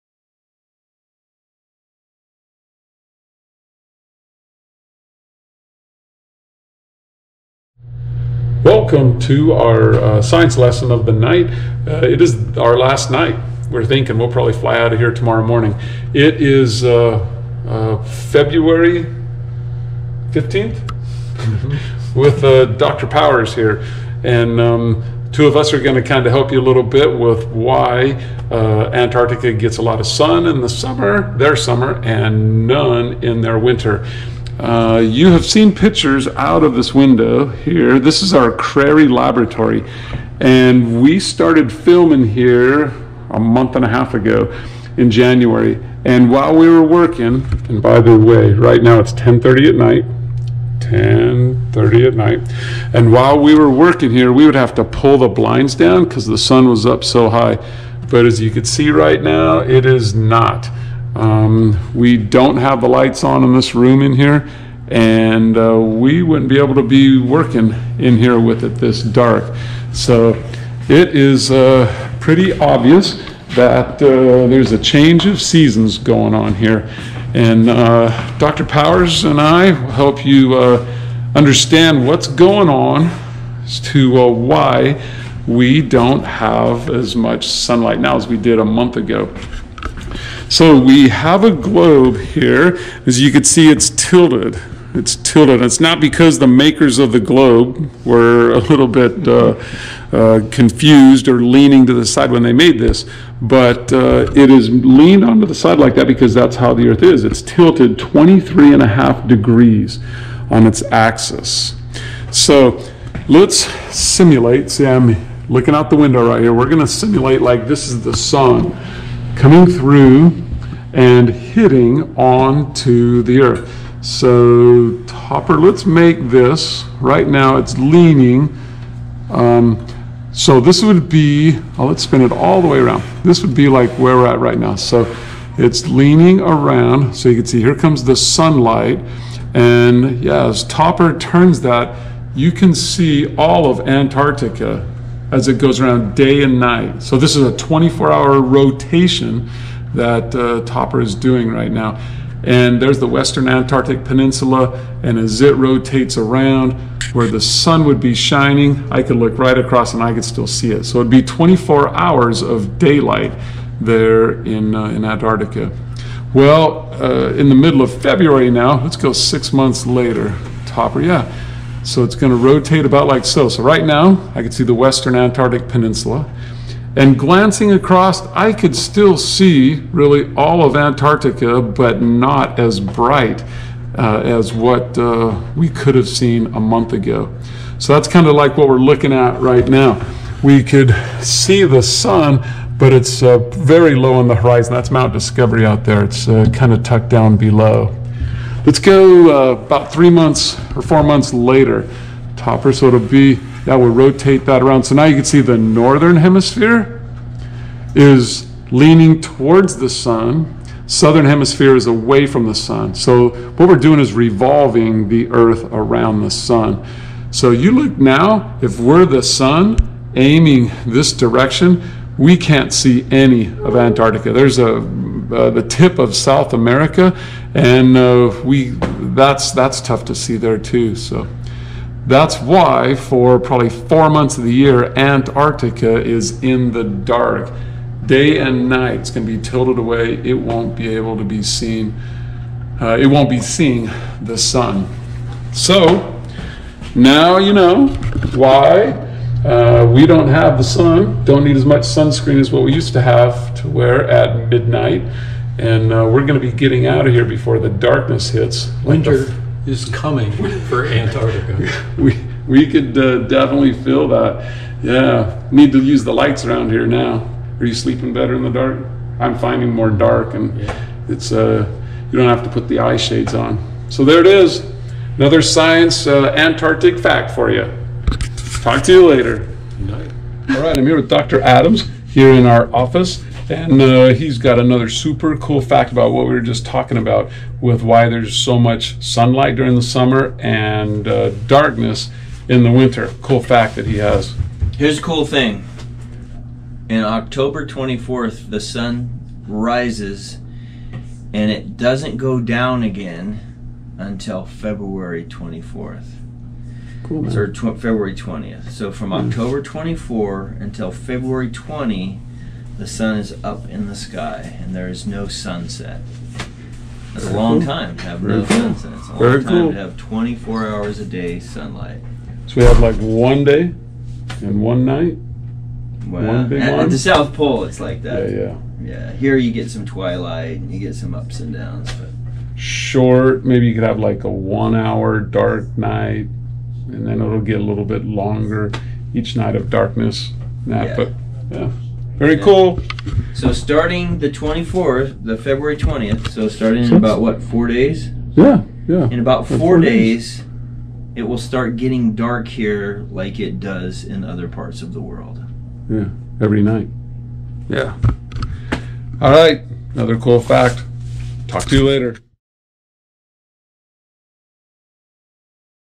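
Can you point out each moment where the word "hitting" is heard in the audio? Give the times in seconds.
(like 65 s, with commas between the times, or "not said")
121 s.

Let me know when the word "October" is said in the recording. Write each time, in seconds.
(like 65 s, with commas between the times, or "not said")
297 s, 309 s.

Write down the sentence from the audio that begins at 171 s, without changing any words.
So it's gonna rotate about like so.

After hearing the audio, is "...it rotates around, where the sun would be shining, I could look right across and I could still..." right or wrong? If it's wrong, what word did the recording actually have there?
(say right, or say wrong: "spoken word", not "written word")
right.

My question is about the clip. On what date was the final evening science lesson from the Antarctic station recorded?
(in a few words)
February 15th.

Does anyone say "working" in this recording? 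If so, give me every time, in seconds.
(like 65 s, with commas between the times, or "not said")
46 s, 53 s, 67 s.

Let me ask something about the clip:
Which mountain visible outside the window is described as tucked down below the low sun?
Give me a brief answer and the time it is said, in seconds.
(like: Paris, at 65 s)
Mount Discovery, at 194 s.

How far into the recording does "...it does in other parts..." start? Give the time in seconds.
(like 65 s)
353 s.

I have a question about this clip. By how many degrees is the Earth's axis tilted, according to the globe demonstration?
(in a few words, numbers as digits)
23 and a half degrees.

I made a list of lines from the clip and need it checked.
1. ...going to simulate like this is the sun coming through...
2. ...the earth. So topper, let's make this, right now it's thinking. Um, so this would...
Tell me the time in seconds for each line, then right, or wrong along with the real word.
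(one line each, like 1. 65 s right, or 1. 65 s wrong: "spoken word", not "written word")
1. 116 s right
2. 123 s wrong: "leaning", not "thinking".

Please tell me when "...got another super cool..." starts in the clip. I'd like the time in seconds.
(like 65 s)
284 s.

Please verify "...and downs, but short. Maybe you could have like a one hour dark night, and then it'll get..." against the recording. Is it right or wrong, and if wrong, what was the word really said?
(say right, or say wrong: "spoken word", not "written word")
right.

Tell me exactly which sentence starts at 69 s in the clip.
So it is uh, pretty obvious that uh, there's a change of seasons going on here.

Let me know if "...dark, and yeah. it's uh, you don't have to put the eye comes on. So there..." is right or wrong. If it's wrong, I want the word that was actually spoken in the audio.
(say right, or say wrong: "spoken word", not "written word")
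wrong: "shades", not "comes".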